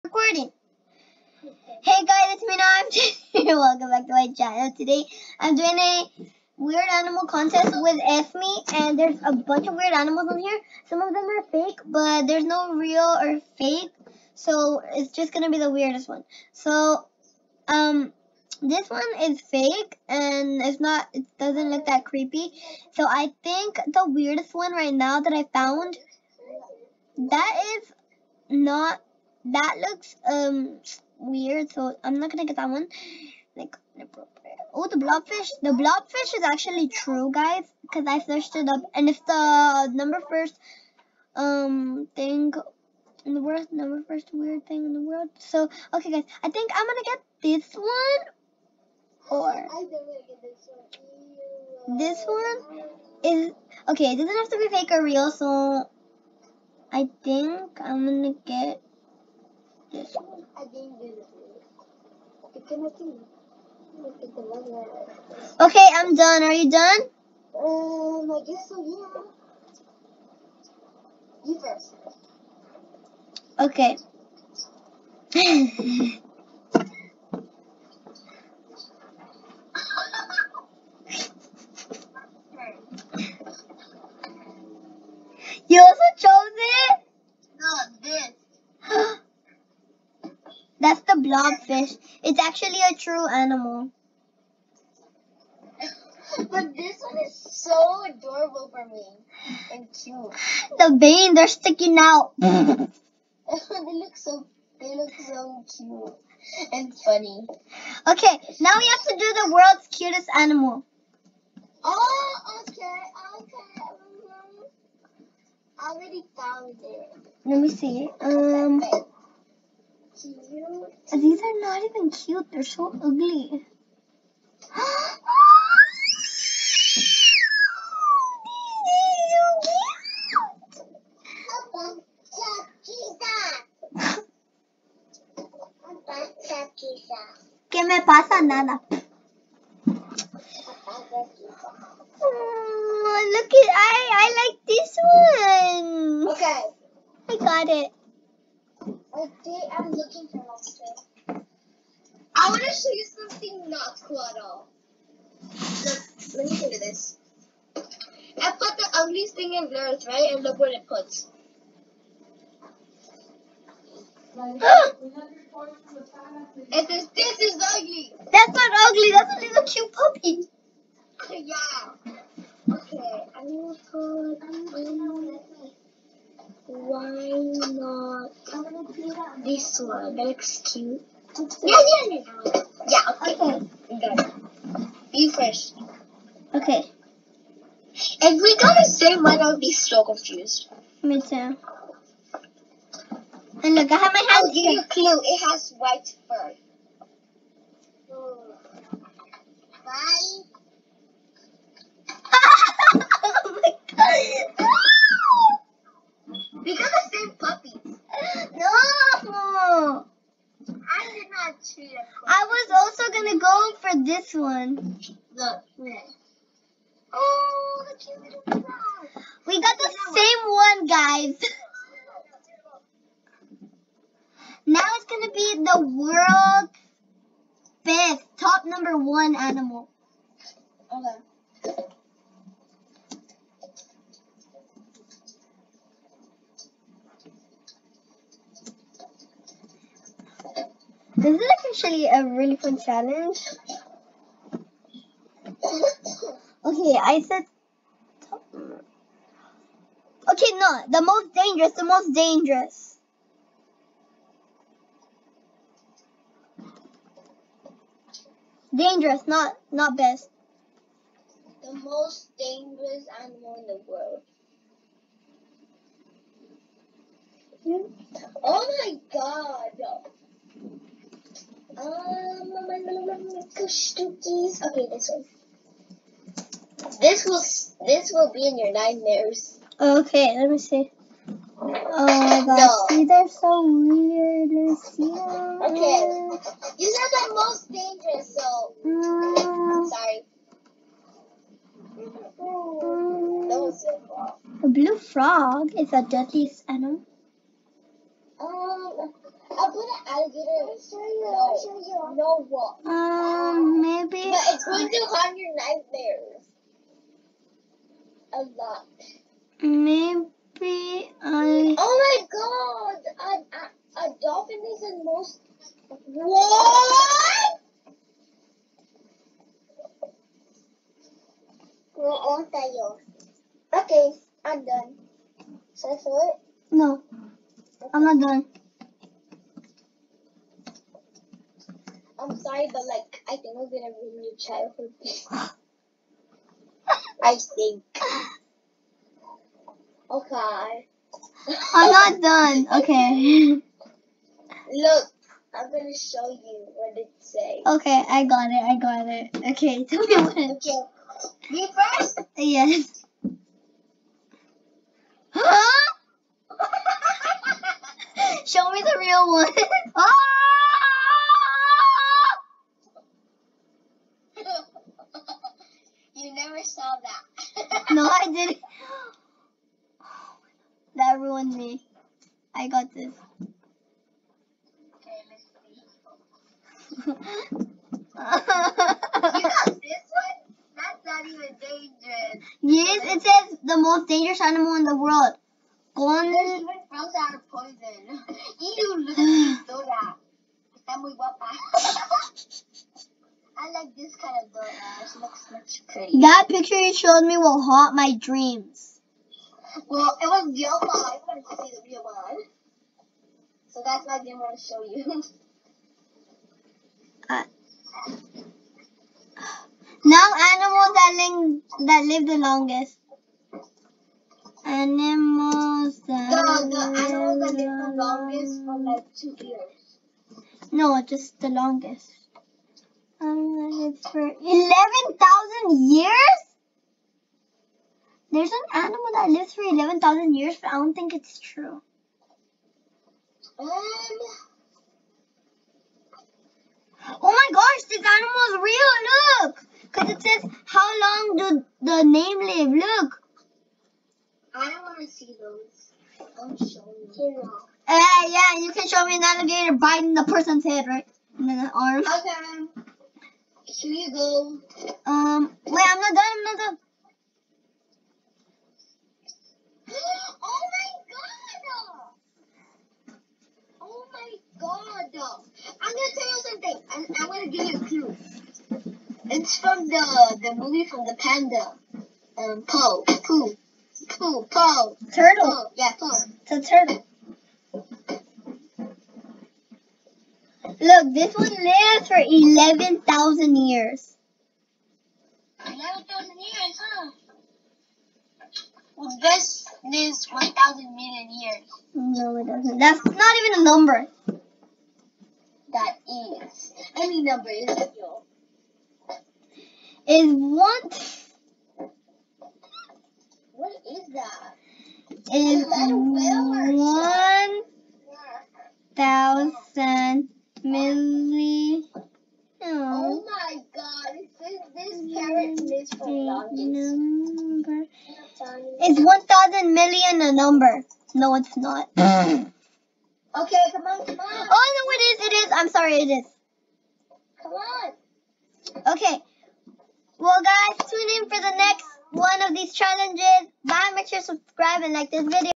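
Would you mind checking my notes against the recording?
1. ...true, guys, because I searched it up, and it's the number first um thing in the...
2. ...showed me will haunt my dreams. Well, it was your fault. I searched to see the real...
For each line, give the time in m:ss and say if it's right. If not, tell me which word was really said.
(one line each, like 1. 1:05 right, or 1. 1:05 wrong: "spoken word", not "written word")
1. 0:36 right
2. 6:36 wrong: "wanted", not "searched".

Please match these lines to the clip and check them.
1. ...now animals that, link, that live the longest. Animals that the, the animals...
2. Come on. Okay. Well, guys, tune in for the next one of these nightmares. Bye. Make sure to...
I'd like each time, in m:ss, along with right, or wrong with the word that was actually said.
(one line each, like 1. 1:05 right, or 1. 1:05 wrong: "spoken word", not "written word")
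1. 6:50 right
2. 8:47 wrong: "challenges", not "nightmares".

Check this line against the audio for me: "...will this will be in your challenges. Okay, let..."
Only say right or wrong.
wrong.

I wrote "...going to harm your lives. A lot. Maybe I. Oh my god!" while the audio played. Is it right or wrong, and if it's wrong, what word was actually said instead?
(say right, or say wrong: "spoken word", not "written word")
wrong: "nightmares", not "lives".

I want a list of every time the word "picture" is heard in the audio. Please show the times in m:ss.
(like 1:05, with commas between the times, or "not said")
6:36.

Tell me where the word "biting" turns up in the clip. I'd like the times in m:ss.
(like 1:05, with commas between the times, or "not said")
7:29.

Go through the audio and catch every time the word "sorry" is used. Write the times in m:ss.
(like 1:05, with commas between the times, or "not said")
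4:49, 5:32, 8:45.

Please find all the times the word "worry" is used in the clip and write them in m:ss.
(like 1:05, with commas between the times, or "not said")
not said.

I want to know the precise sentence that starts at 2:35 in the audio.
Look, let me show you this.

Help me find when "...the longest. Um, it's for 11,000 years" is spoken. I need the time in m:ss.
7:01.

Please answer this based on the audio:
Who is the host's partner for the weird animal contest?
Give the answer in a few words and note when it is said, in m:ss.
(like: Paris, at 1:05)
Esme, at 0:08.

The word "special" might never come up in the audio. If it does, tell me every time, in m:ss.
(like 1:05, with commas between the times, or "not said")
not said.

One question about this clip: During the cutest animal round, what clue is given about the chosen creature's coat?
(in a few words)
White fur.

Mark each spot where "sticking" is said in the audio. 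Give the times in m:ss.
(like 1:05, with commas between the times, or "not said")
1:41.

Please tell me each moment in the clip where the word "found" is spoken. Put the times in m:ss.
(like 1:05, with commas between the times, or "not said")
0:25, 1:56.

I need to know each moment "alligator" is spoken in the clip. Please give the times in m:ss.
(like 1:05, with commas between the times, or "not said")
5:00, 7:29.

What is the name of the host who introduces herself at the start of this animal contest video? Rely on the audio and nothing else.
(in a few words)
Jessie.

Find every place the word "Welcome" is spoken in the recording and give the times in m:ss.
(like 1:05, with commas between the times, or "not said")
0:03.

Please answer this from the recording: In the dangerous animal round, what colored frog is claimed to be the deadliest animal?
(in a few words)
Blue.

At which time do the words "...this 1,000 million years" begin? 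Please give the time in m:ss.
8:09.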